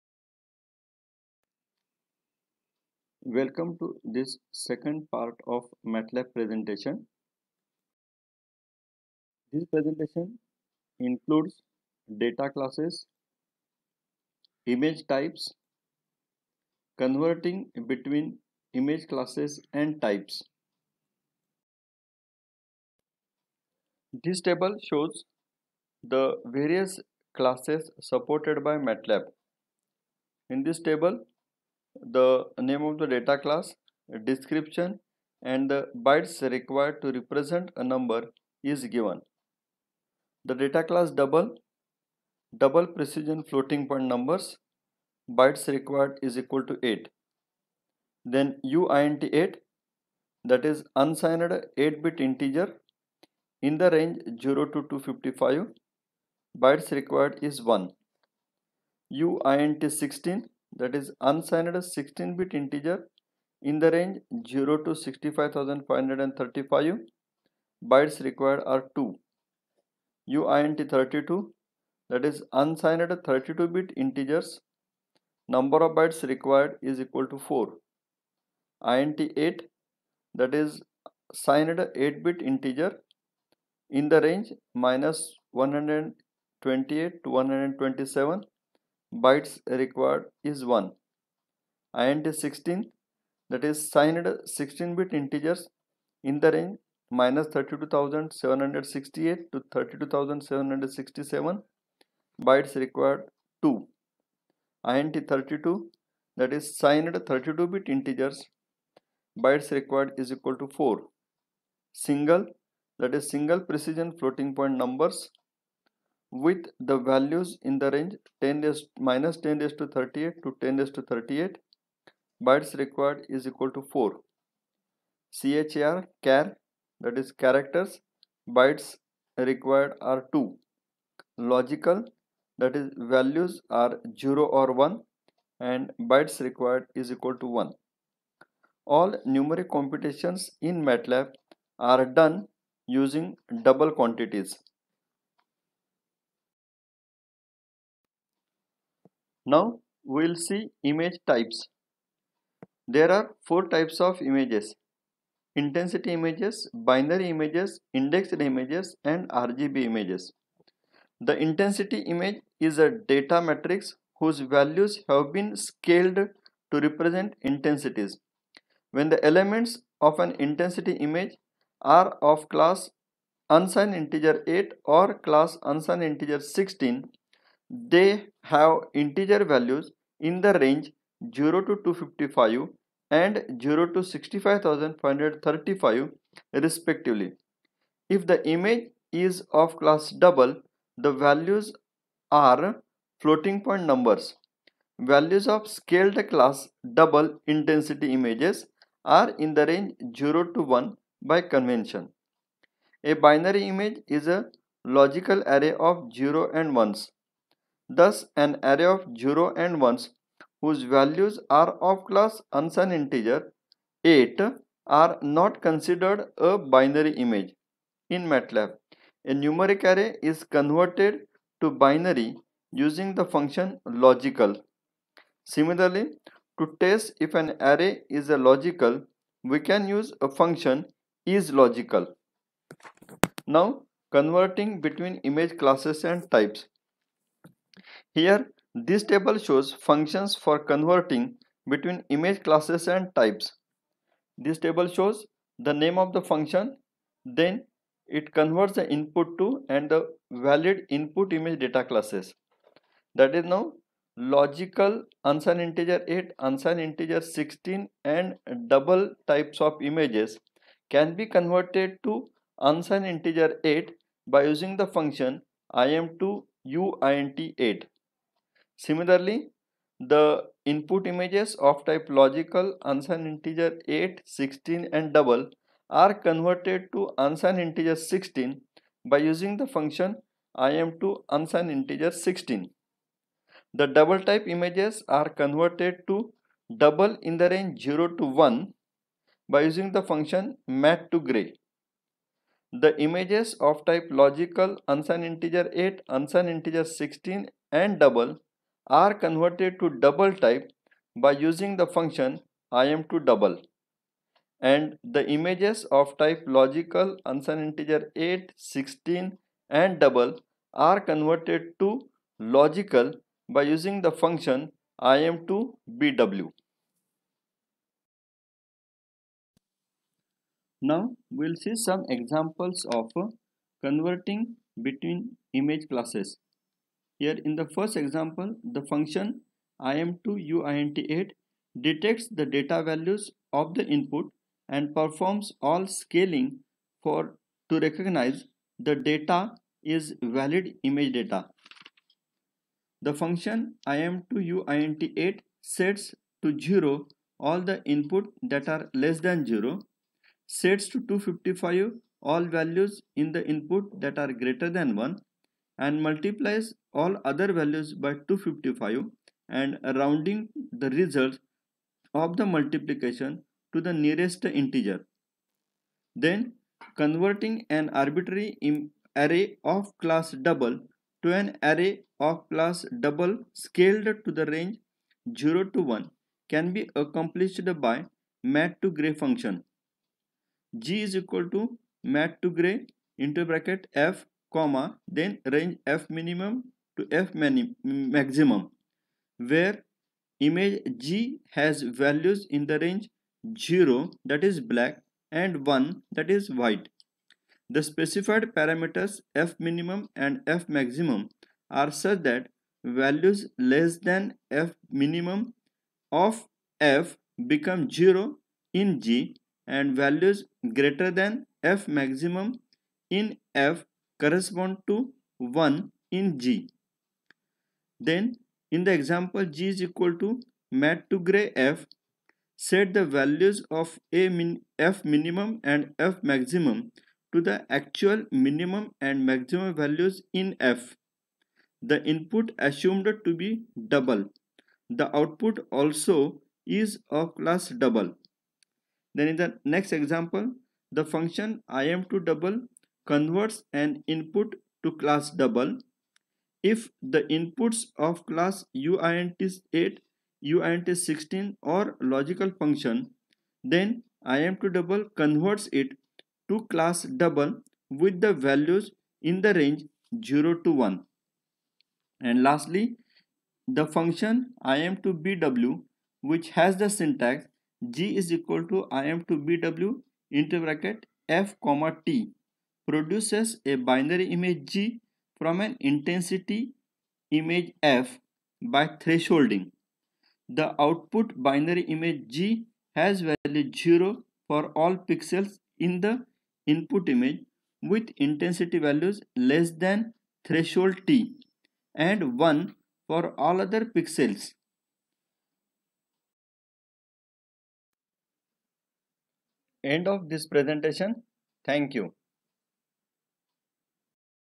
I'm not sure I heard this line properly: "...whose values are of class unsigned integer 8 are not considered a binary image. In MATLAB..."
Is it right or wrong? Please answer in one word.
right.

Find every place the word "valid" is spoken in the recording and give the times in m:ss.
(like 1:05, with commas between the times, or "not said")
4:10, 5:40.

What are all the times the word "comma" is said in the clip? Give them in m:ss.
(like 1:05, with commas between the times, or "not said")
6:24, 7:51.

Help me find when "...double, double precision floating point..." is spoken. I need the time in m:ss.
0:41.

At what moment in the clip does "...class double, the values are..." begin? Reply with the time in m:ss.
3:09.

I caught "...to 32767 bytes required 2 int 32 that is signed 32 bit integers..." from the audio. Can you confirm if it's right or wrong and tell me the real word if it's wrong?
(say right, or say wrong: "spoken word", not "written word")
right.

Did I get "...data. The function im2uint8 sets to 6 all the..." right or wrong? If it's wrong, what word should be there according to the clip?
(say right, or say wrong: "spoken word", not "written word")
wrong: "0", not "6".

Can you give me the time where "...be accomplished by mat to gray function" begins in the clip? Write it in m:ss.
6:16.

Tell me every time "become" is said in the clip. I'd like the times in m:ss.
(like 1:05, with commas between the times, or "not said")
6:47.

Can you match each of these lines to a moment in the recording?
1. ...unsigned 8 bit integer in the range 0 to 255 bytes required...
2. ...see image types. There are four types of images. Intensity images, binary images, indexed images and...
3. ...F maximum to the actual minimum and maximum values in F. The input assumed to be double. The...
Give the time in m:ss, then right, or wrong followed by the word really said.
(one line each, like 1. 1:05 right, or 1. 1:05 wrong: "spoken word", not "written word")
1. 0:50 right
2. 2:30 right
3. 7:06 right.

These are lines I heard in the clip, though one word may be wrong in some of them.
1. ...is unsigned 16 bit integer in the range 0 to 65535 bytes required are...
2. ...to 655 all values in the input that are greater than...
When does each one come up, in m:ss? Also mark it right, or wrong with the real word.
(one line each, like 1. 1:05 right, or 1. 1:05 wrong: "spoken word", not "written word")
1. 1:00 right
2. 5:50 wrong: "255", not "655".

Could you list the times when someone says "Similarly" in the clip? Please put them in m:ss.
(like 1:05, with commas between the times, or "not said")
3:45, 4:28.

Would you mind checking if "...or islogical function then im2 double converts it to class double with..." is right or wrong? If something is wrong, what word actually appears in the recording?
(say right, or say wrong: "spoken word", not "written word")
wrong: "logical", not "islogical".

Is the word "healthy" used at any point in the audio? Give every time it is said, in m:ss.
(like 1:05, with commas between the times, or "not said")
not said.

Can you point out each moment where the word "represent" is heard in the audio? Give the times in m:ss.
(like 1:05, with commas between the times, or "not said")
0:37, 2:46.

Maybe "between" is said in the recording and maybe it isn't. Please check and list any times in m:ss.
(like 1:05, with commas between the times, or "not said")
0:17, 3:54, 4:01, 5:24.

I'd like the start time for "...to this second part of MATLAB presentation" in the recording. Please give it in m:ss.
0:03.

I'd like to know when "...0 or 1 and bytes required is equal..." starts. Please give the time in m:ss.
2:14.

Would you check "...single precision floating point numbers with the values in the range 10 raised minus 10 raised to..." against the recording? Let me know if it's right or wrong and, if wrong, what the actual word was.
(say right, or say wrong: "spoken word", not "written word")
right.